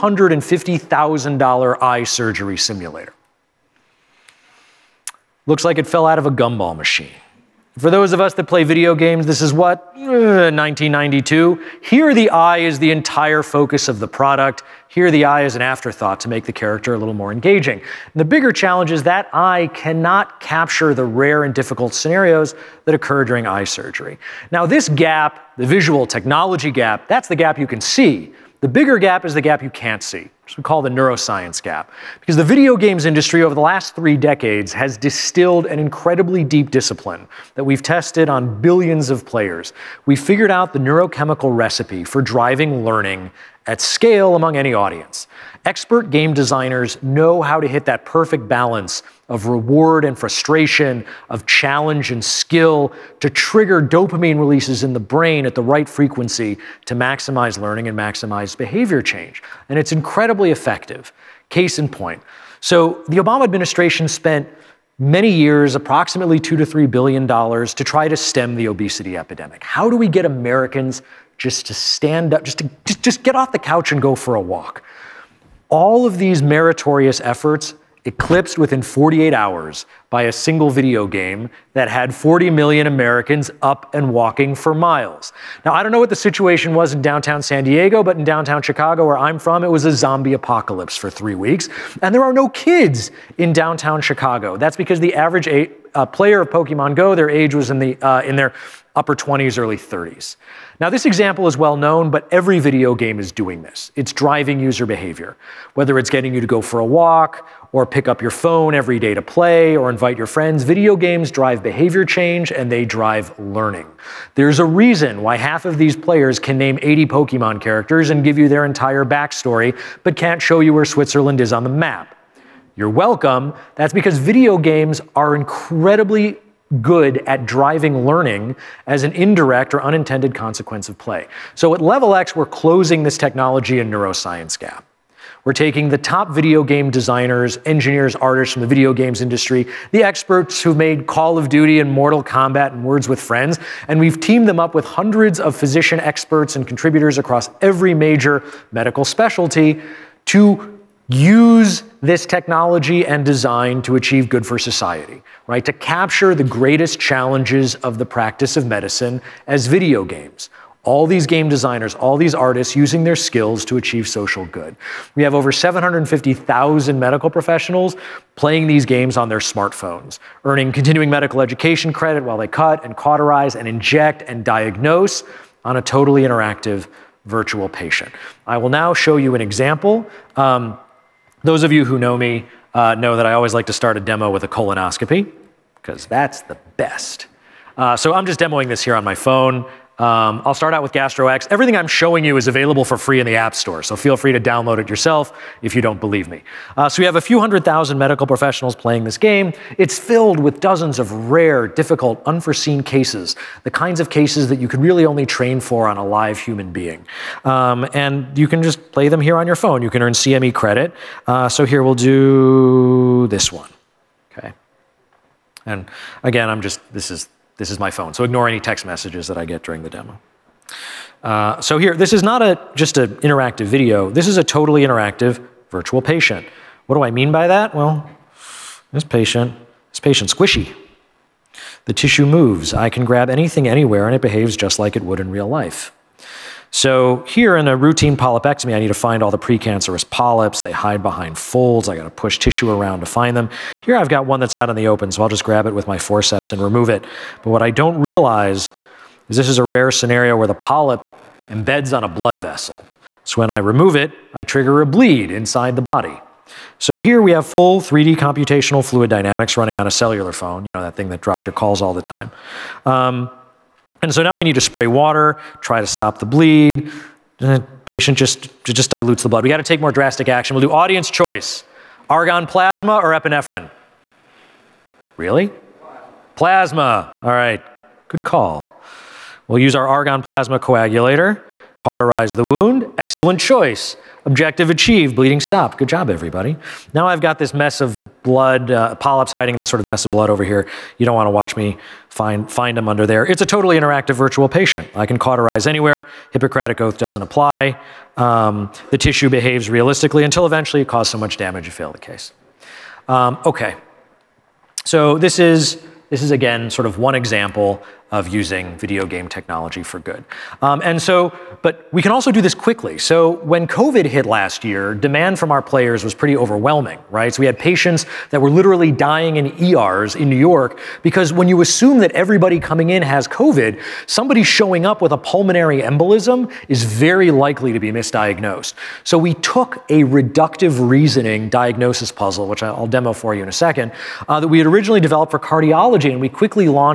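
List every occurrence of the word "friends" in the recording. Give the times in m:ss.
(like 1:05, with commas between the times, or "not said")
1:50, 2:23.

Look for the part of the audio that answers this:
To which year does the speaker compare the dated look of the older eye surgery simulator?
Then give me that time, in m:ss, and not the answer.
0:09.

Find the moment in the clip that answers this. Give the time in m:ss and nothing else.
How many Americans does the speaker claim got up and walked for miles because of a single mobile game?
1:22.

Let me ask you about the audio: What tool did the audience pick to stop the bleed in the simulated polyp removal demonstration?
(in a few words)
argon plasma coagulator.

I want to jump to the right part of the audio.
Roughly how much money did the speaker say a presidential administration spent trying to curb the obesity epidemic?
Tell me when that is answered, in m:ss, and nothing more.
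1:06.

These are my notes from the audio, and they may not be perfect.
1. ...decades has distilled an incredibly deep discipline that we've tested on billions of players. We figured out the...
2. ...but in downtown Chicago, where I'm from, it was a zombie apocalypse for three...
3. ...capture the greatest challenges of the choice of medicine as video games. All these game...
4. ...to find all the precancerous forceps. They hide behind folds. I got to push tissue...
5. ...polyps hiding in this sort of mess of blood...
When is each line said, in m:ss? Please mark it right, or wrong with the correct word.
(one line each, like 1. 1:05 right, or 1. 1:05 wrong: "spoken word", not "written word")
1. 0:34 right
2. 1:28 right
3. 2:35 wrong: "practice", not "choice"
4. 3:58 wrong: "polyps", not "forceps"
5. 4:48 right.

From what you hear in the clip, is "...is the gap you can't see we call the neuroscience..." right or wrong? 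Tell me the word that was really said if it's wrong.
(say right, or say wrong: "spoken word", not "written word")
right.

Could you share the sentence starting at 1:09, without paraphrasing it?
How do we get Americans just to stand up, just to just, just get off the couch and go for a walk?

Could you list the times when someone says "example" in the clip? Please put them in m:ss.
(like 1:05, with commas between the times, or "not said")
1:41, 2:59, 5:07.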